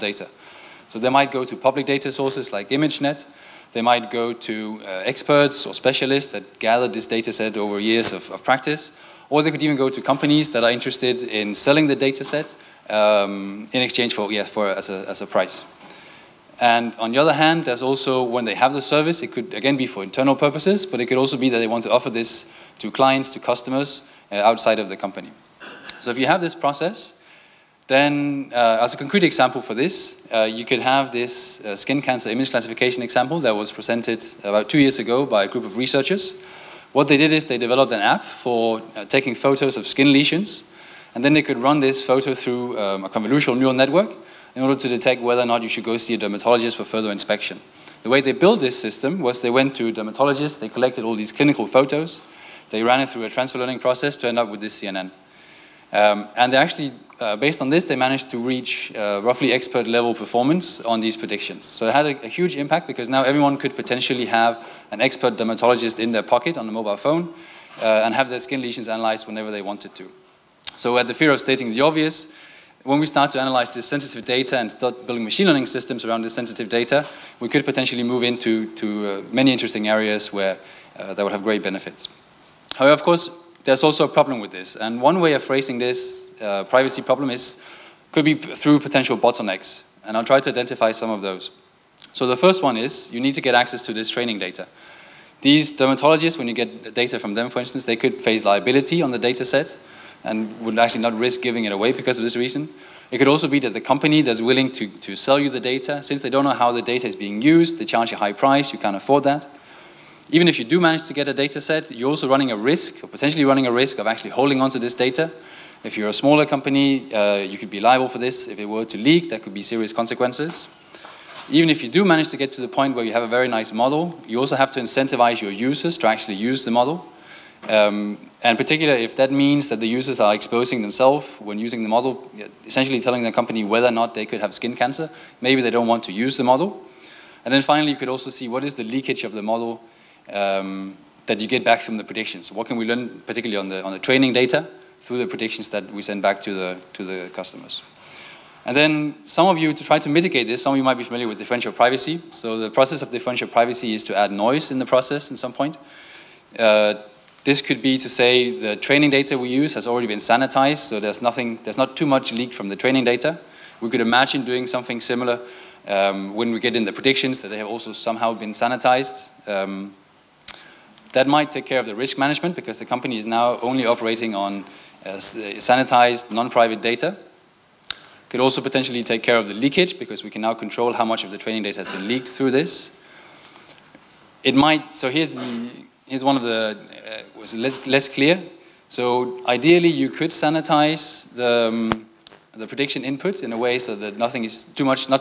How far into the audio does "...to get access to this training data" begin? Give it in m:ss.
1:33.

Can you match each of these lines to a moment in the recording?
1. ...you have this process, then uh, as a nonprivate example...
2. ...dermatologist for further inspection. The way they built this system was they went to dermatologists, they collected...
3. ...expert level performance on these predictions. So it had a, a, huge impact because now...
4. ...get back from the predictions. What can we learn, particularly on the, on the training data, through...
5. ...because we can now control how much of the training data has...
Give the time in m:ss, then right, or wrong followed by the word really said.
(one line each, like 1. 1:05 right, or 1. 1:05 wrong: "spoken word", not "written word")
1. 0:26 wrong: "concrete", not "nonprivate"
2. 0:46 right
3. 0:59 right
4. 2:21 right
5. 2:59 right.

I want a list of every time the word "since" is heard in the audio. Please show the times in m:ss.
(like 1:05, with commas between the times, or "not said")
1:46.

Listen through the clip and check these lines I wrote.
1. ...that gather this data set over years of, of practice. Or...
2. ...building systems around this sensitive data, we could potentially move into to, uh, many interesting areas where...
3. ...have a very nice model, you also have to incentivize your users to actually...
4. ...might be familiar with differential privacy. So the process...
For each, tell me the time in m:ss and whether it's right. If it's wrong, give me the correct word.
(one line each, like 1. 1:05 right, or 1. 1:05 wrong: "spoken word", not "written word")
1. 0:06 right
2. 1:15 wrong: "learning", not "building"
3. 2:03 right
4. 2:30 right.